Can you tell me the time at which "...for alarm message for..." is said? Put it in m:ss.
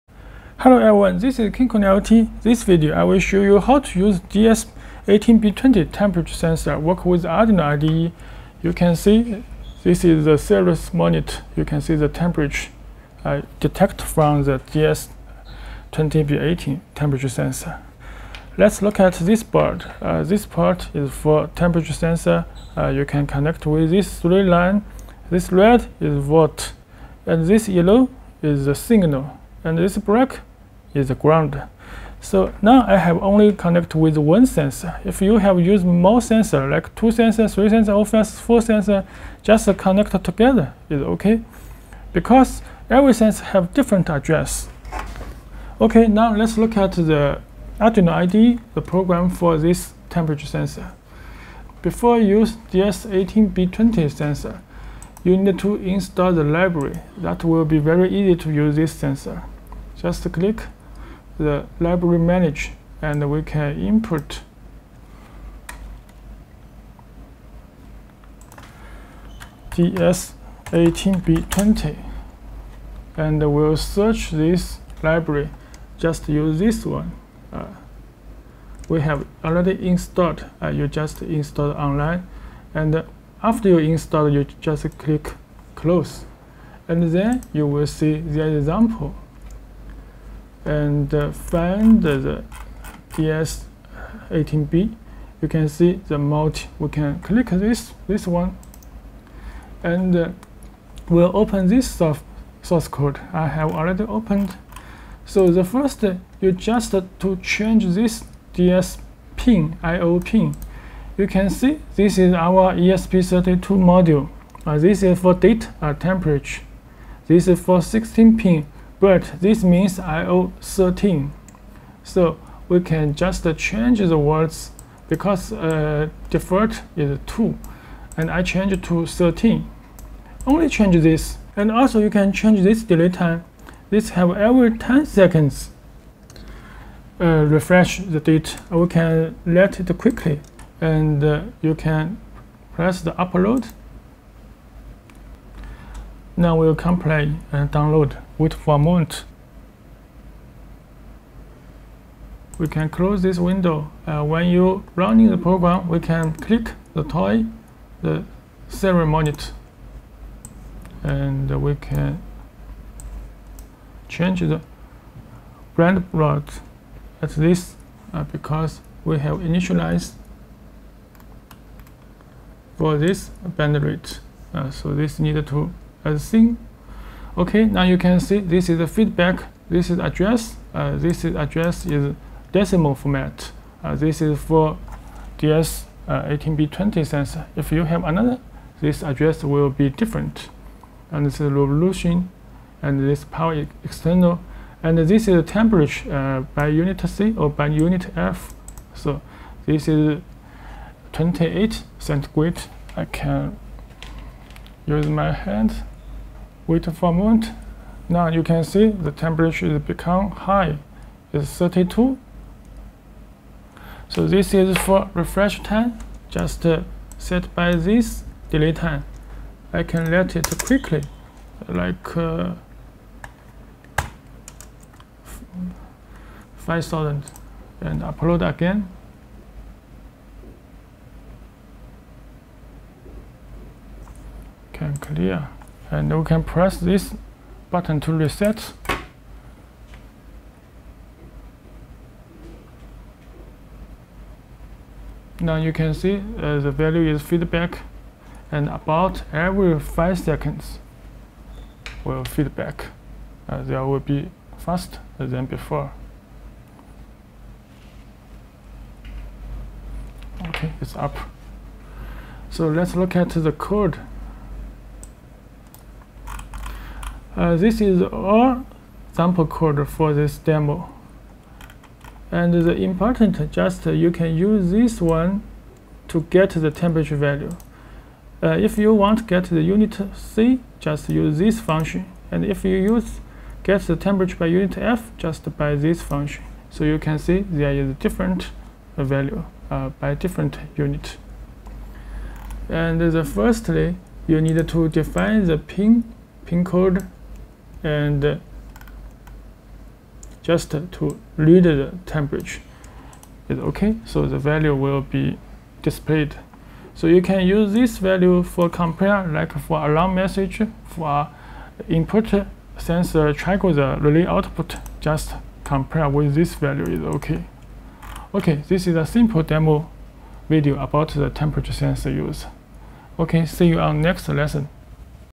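5:09.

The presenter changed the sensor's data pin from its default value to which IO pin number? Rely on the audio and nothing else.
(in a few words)
13.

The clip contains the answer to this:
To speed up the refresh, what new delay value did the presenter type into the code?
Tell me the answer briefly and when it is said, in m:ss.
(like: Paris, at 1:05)
5000, at 3:46.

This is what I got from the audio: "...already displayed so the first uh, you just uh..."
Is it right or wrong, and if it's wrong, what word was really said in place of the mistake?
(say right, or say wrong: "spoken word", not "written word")
wrong: "opened", not "displayed".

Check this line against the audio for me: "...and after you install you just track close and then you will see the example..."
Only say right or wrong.
wrong.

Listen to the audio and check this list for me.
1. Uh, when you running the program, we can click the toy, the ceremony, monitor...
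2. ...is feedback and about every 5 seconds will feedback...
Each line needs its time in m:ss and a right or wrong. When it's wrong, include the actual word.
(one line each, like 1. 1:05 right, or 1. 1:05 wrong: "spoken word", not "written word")
1. 2:34 right
2. 4:07 right.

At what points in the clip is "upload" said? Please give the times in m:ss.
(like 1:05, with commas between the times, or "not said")
2:23, 3:48.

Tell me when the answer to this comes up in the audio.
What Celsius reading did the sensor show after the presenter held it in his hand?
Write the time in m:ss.
3:31.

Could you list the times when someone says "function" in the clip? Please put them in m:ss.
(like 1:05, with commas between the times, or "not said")
4:41, 4:45.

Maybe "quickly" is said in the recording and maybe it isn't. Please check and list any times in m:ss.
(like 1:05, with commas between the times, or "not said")
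2:19, 3:40.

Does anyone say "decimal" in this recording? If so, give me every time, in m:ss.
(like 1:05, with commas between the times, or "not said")
3:02.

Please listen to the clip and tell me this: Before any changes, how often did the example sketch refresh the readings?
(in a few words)
Every 10 seconds.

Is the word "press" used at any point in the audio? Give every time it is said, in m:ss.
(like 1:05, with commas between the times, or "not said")
2:22, 3:56.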